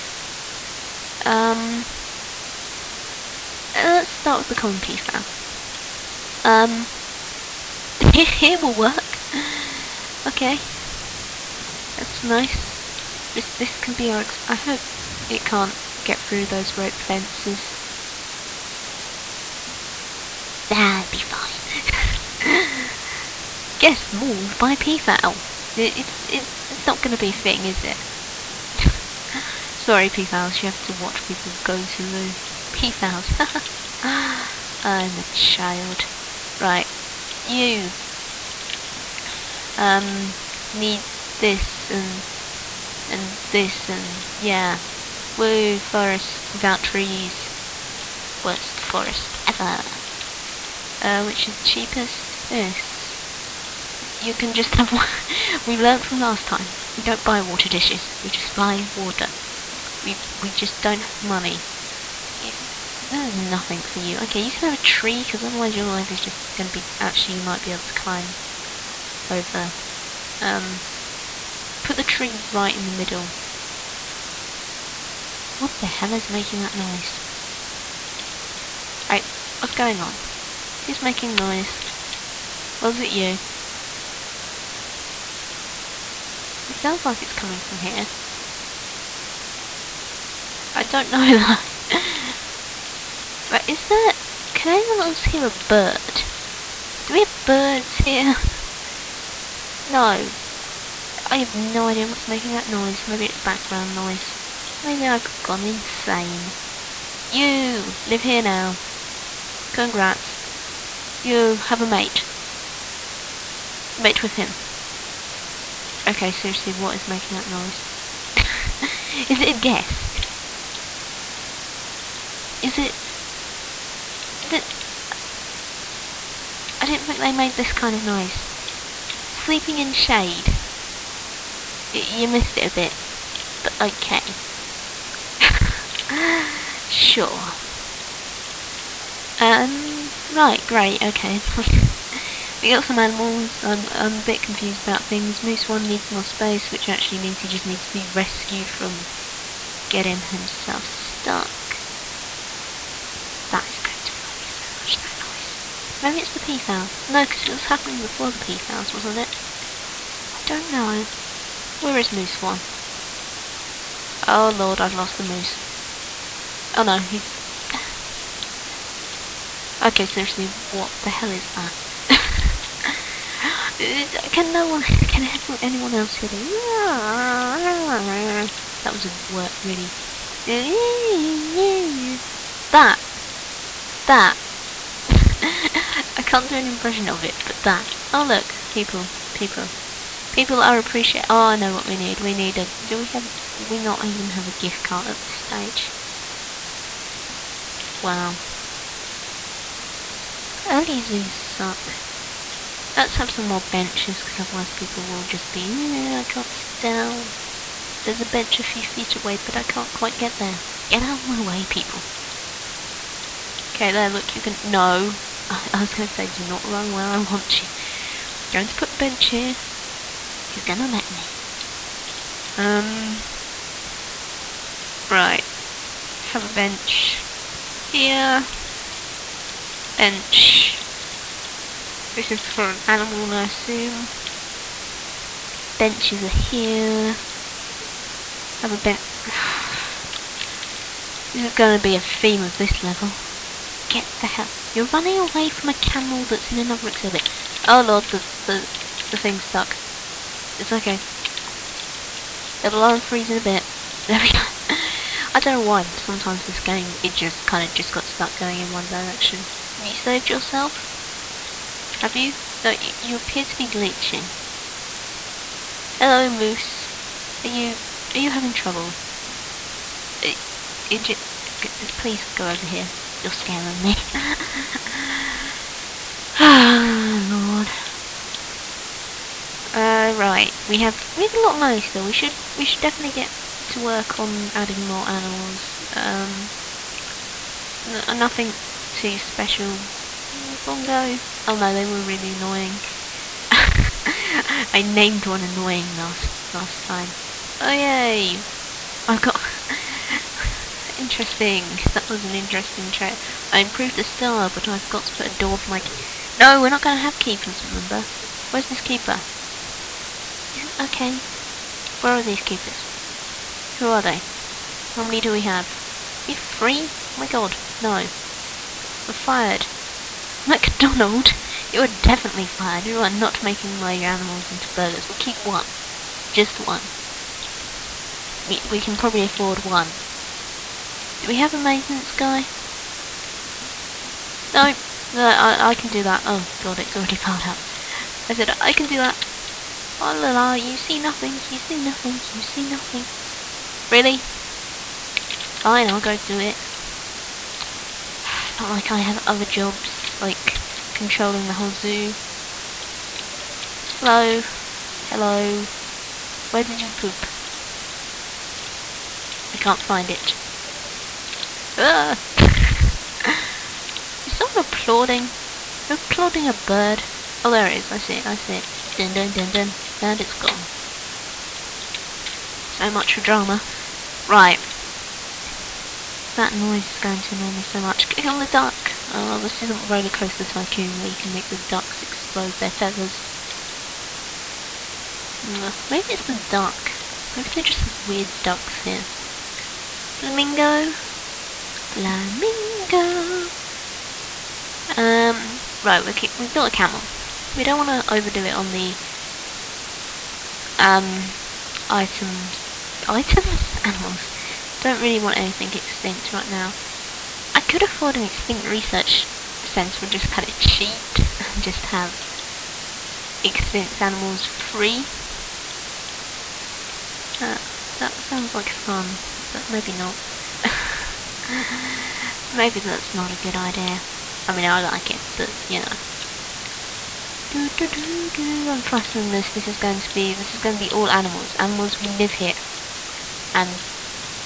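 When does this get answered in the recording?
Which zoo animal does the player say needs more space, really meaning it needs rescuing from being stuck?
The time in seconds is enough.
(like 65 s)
145 s.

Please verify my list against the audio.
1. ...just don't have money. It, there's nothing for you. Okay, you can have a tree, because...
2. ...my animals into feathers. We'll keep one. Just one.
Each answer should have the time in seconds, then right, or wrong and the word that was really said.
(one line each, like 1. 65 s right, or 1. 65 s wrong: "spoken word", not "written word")
1. 60 s right
2. 323 s wrong: "burgers", not "feathers".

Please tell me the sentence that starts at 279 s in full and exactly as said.
Uh, right, we have we have a lot nice though.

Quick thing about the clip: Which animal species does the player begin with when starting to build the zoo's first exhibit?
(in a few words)
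Common peafowl.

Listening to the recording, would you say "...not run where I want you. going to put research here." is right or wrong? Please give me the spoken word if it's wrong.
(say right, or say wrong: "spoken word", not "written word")
wrong: "bench", not "research".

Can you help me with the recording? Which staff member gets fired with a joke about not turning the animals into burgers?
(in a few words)
MacDonald.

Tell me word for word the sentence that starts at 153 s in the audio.
That is going to annoy me so much, that noise.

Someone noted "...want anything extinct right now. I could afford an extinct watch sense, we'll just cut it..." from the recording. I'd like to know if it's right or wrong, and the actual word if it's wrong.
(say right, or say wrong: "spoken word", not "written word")
wrong: "research", not "watch".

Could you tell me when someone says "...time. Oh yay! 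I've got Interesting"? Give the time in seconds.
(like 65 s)
296 s.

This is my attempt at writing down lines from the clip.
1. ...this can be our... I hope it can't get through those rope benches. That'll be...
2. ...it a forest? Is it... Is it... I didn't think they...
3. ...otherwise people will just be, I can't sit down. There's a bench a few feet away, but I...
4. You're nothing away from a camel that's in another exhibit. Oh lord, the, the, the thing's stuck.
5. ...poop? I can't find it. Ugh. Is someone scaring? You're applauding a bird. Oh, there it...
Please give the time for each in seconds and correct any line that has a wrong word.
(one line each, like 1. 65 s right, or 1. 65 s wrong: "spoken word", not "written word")
1. 13 s wrong: "fences", not "benches"
2. 119 s wrong: "guest", not "forest"
3. 204 s right
4. 244 s wrong: "running", not "nothing"
5. 356 s wrong: "applauding", not "scaring".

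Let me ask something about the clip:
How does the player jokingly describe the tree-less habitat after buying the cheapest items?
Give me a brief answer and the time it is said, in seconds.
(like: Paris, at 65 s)
Worst forest ever, at 48 s.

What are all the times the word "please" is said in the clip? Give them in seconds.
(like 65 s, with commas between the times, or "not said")
271 s.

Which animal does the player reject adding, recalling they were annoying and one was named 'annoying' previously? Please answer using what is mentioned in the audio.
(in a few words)
Bongo.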